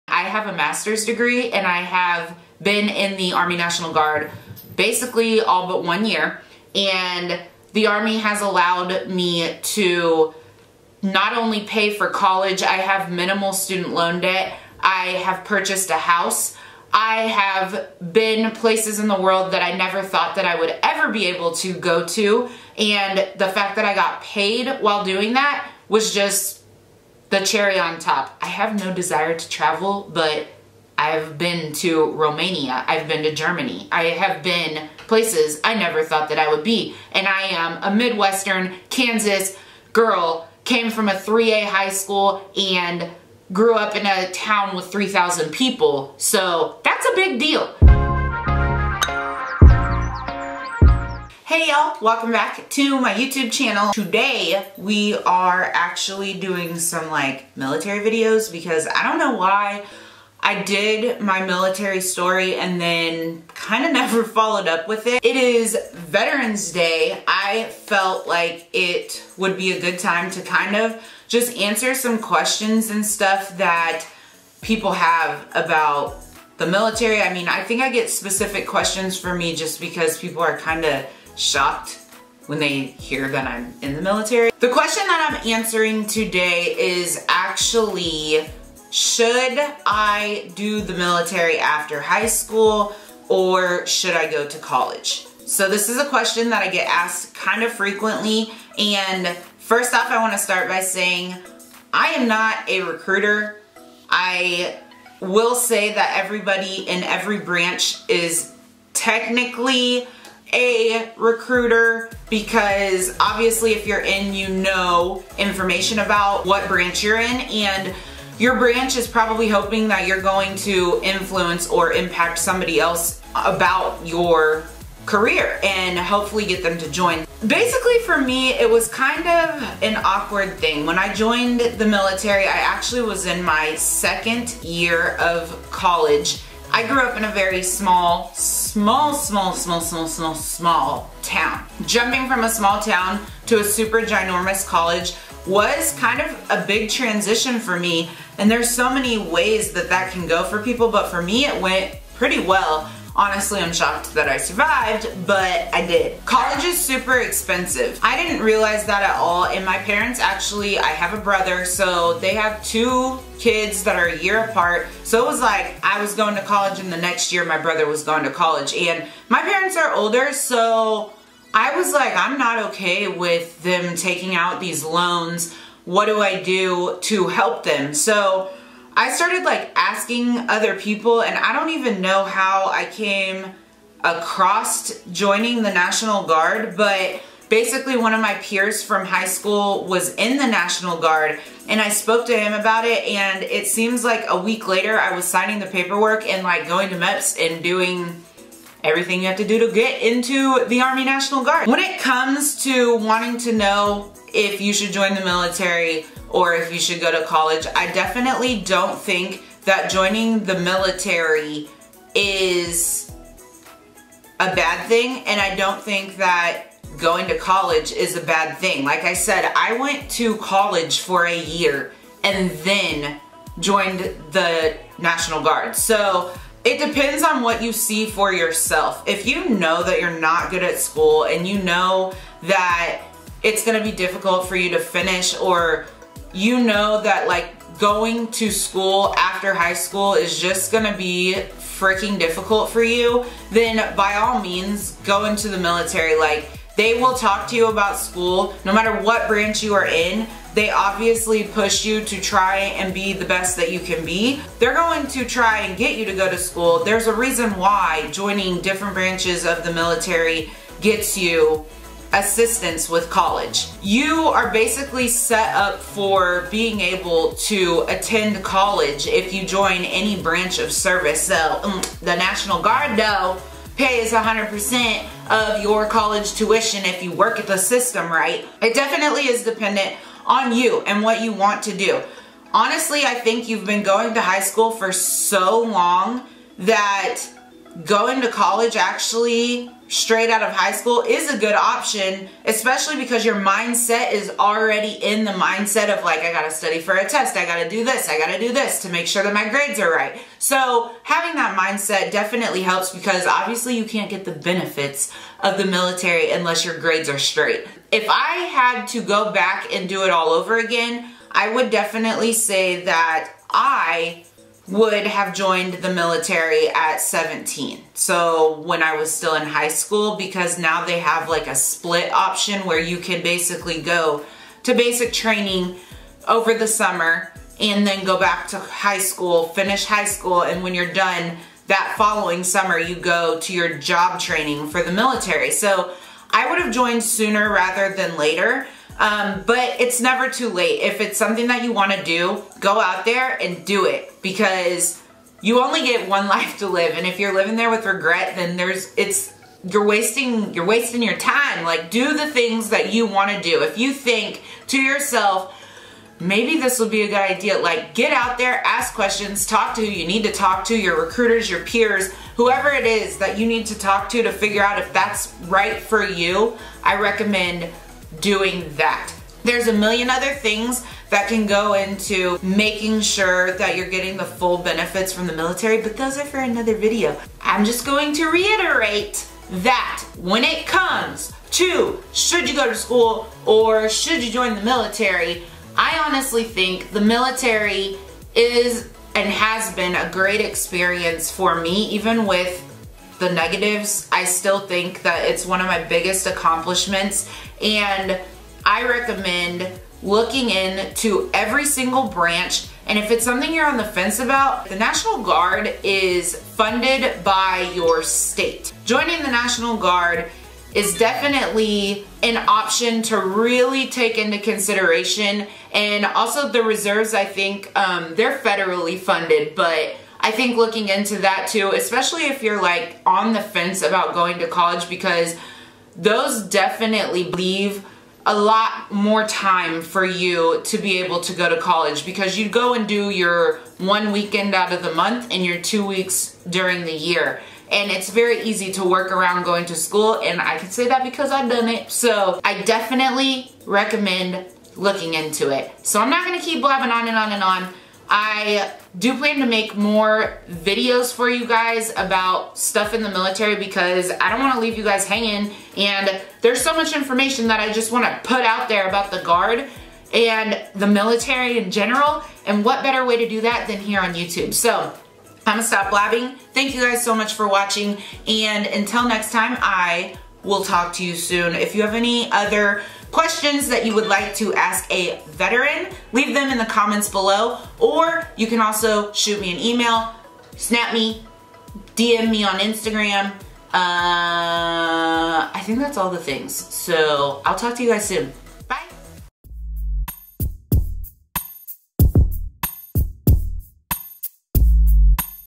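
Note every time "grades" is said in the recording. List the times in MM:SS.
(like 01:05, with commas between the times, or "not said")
04:59, 05:06.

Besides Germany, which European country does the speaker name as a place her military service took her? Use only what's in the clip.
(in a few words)
Romania.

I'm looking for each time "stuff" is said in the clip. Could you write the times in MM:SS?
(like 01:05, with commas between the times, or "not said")
01:13, 07:32.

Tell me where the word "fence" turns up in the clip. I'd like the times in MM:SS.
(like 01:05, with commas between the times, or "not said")
06:43, 07:03.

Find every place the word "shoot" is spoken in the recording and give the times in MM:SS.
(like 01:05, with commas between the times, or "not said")
07:59.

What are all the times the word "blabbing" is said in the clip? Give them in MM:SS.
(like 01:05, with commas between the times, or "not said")
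07:26, 07:45.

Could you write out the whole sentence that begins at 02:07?
Basically for me, it was kind of an awkward thing.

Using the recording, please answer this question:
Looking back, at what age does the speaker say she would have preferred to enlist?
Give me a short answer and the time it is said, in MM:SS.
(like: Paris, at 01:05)
17, at 05:17.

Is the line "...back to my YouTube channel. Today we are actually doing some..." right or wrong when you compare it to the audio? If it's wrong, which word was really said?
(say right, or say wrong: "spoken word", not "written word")
right.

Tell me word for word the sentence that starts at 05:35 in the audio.
So I would have joined sooner rather than later um, but it's never too late.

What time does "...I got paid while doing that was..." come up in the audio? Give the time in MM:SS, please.
00:23.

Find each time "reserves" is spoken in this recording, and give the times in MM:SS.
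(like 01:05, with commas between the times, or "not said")
06:56.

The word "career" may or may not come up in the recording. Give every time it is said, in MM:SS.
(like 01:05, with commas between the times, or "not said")
02:05.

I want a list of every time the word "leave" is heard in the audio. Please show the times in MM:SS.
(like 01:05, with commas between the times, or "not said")
07:07, 07:34, 07:56.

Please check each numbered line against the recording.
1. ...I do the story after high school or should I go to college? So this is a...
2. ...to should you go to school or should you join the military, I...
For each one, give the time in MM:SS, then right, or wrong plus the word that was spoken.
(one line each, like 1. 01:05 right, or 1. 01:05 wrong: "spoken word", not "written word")
1. 01:29 wrong: "military", not "story"
2. 06:21 right.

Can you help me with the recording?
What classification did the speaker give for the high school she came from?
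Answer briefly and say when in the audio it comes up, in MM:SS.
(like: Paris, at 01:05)
3A, at 00:41.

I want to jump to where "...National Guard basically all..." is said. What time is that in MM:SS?
00:03.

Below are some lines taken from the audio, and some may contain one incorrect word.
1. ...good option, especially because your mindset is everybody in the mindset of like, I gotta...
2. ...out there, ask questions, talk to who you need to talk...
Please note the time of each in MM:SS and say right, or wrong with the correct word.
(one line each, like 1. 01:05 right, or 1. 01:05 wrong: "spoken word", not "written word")
1. 04:51 wrong: "already", not "everybody"
2. 05:58 right.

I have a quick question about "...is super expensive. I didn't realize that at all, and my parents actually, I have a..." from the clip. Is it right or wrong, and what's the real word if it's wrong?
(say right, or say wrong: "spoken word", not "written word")
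right.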